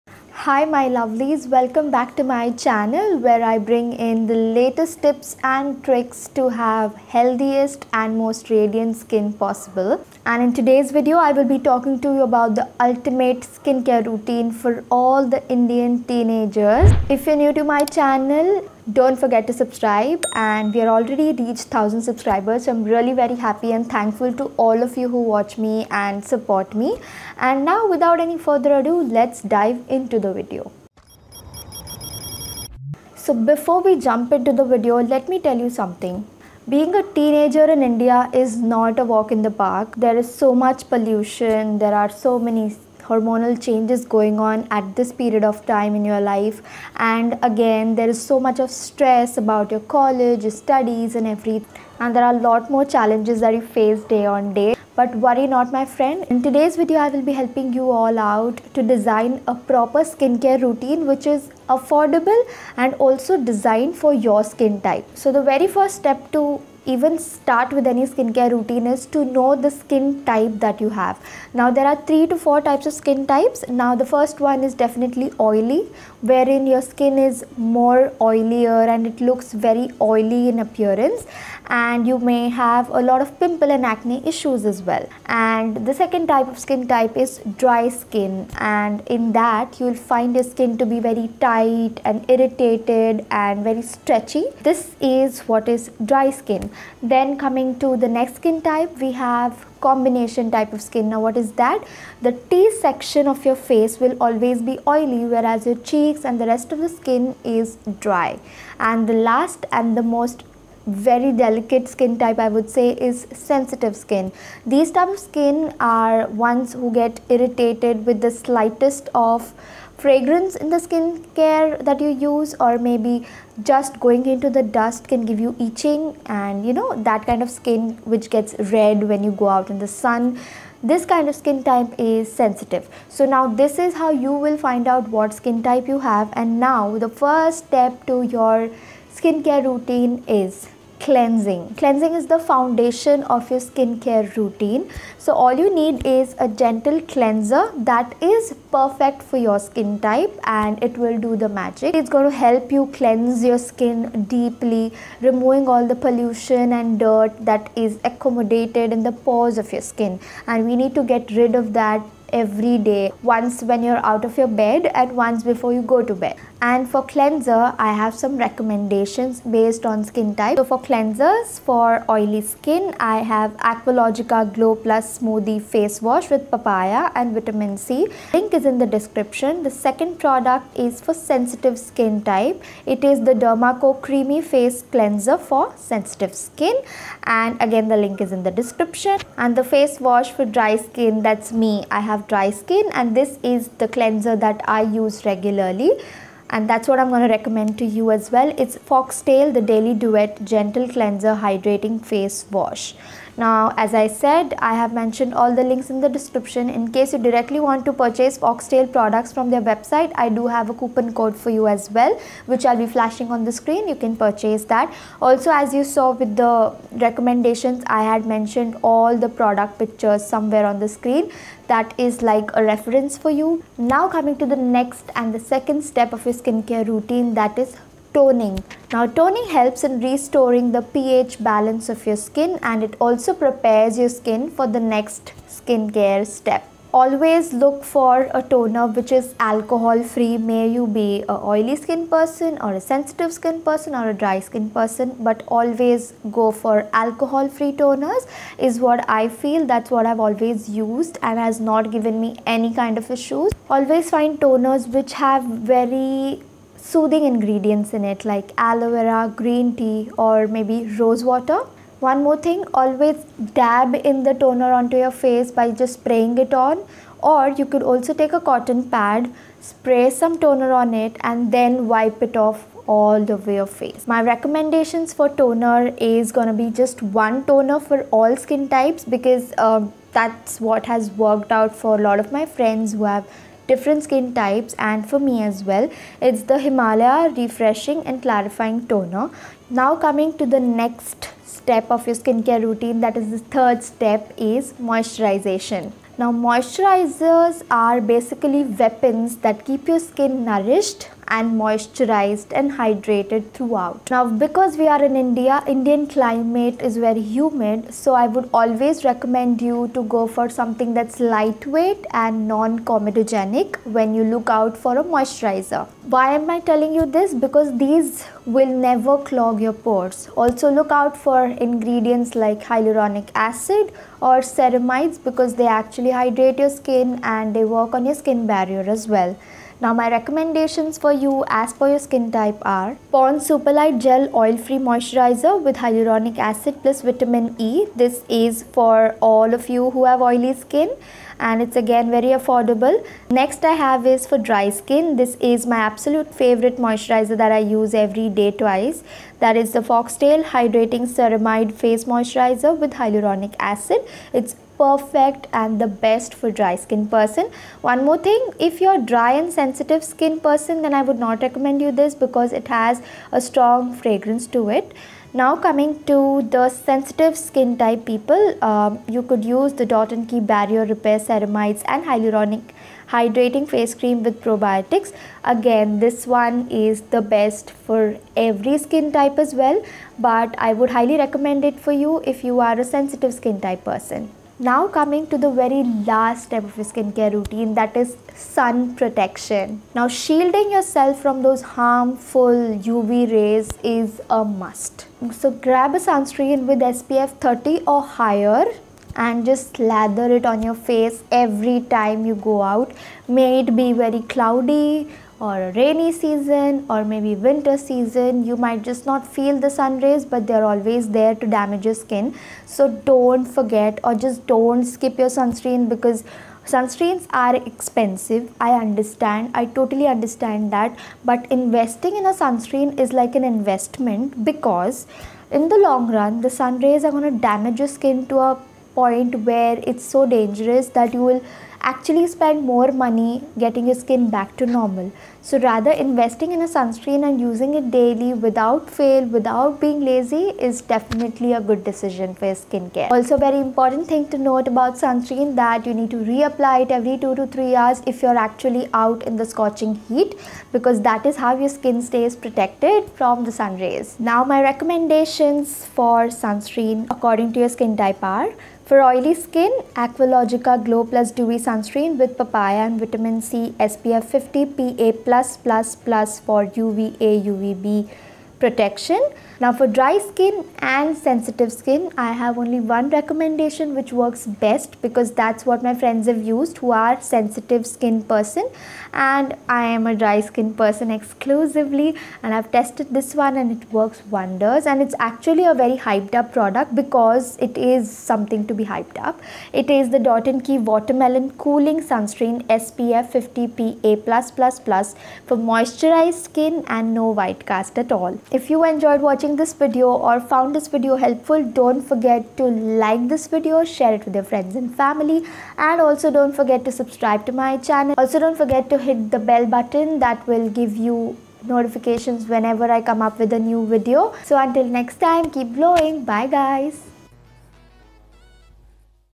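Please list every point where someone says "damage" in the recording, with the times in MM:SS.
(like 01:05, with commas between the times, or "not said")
06:51, 07:07.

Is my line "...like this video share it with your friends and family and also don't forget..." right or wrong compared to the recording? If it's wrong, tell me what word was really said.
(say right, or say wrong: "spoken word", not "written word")
right.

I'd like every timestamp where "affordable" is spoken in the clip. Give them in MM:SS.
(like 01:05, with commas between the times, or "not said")
01:01, 05:42.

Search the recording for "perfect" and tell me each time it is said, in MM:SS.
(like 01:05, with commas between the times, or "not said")
02:28, 05:54.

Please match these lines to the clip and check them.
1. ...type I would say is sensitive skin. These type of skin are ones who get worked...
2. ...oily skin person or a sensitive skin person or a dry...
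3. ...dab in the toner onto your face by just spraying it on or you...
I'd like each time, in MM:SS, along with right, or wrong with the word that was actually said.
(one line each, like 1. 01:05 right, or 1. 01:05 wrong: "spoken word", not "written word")
1. 01:52 wrong: "irritated", not "worked"
2. 04:01 right
3. 04:23 right.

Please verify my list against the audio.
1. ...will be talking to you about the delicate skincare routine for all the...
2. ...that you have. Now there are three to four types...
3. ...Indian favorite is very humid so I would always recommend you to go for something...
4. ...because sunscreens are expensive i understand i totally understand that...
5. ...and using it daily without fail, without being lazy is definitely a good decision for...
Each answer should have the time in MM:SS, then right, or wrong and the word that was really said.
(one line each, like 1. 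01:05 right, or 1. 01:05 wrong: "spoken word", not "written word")
1. 00:11 wrong: "ultimate", not "delicate"
2. 01:10 right
3. 05:05 wrong: "climate", not "favorite"
4. 06:55 right
5. 07:17 right.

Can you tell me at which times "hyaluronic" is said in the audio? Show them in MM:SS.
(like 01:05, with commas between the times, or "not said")
05:22, 05:35, 05:53, 06:12.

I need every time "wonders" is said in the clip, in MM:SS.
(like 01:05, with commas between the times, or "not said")
08:04.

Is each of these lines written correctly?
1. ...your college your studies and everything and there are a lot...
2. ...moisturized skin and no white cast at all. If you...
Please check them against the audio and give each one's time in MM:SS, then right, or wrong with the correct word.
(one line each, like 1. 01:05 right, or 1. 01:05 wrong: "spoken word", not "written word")
1. 00:49 right
2. 08:15 right.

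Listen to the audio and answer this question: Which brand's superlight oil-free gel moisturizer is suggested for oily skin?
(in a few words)
Pond's.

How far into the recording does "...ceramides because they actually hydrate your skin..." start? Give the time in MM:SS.
05:24.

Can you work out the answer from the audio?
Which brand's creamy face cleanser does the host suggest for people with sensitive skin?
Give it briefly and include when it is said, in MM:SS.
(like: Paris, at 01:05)
Derma Co, at 03:03.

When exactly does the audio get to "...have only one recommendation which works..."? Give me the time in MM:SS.
07:52.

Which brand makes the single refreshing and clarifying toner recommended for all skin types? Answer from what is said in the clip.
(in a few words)
Himalaya.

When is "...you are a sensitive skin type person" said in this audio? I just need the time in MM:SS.
06:22.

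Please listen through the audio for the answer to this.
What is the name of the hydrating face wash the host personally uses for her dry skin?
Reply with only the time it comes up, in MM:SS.
03:19.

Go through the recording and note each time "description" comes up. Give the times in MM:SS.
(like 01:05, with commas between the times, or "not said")
02:58, 03:08, 03:26.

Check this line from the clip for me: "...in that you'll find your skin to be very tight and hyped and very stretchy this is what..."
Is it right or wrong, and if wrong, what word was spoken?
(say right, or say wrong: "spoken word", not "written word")
wrong: "irritated", not "hyped".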